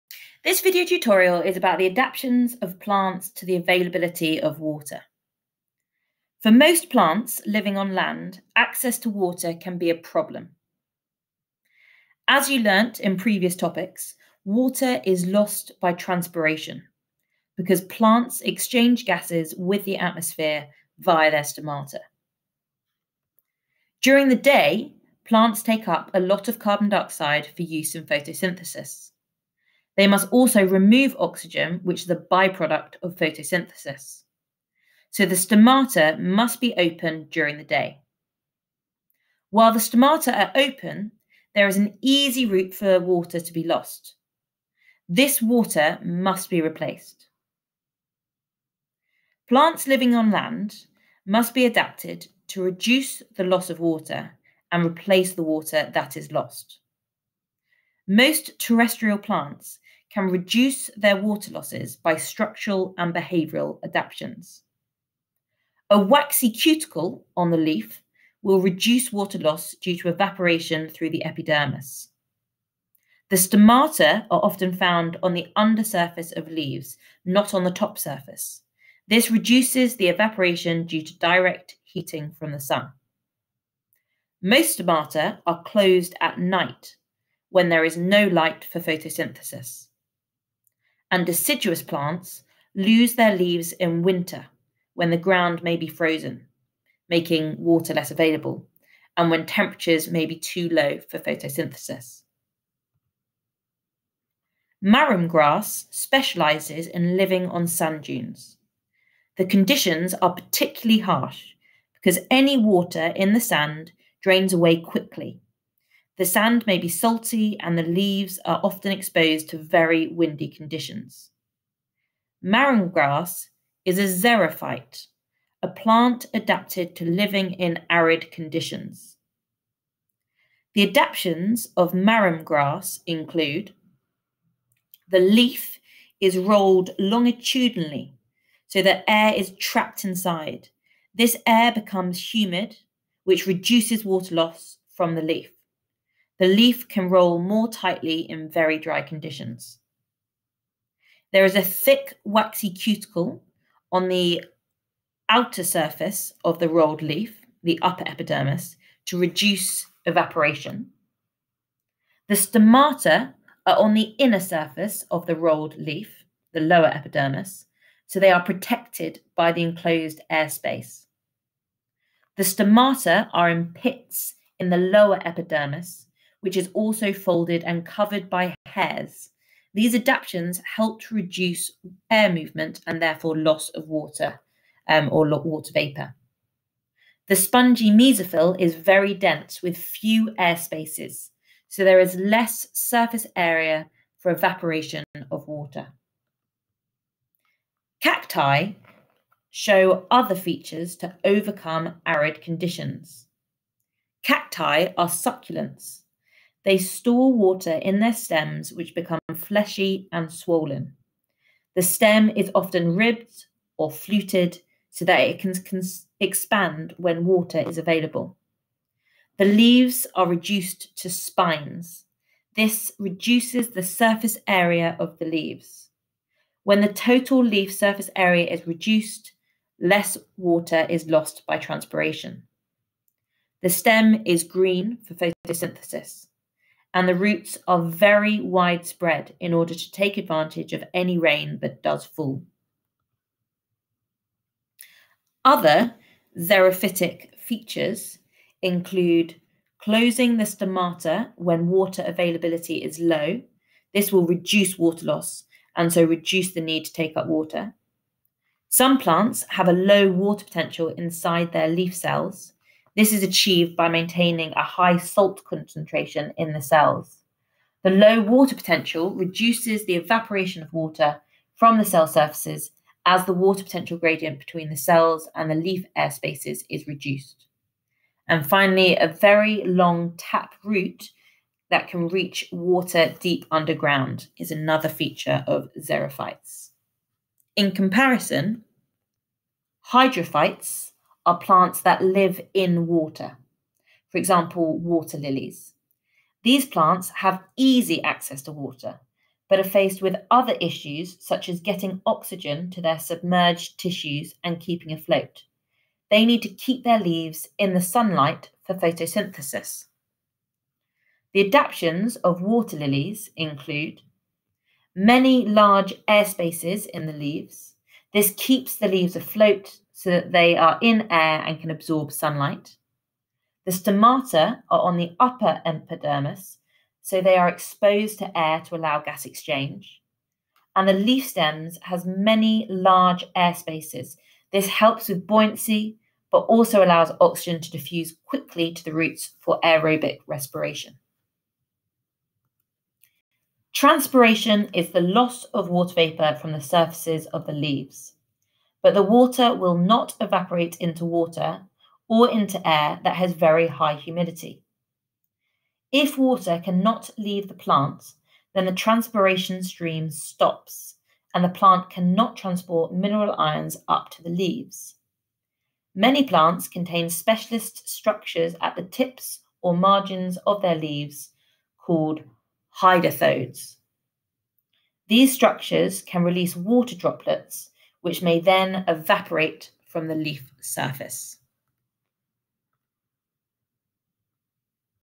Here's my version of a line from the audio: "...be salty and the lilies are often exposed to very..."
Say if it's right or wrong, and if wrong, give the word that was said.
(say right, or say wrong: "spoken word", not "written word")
wrong: "leaves", not "lilies".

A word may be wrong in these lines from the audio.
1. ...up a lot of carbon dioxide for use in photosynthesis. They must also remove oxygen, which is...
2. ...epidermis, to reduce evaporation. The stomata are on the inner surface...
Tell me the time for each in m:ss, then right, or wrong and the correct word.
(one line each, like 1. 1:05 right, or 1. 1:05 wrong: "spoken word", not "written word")
1. 0:25 right
2. 2:38 right.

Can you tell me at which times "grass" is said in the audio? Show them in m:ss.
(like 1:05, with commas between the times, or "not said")
1:45, 2:02, 2:12.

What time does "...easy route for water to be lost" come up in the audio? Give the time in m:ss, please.
0:42.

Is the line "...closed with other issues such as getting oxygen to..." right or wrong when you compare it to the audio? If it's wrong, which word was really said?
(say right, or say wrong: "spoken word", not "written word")
wrong: "faced", not "closed".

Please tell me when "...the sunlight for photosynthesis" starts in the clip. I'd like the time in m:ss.
5:07.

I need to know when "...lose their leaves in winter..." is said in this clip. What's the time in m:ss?
1:32.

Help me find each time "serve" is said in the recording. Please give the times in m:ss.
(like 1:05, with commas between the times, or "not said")
not said.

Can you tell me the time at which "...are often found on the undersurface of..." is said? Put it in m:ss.
1:14.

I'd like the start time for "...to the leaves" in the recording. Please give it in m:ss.
6:04.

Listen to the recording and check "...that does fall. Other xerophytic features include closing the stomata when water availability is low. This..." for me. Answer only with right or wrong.
right.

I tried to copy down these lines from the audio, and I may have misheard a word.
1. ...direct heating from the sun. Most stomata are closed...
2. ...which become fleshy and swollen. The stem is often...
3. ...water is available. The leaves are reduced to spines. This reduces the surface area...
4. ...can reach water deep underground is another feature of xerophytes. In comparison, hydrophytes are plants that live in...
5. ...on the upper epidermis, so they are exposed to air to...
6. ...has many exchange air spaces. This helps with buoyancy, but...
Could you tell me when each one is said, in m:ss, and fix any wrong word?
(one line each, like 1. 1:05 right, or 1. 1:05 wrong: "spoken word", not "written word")
1. 1:21 right
2. 3:28 right
3. 3:37 right
4. 4:41 right
5. 5:24 right
6. 5:31 wrong: "large", not "exchange".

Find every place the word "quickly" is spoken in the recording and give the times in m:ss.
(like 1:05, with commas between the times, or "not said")
1:54, 5:38.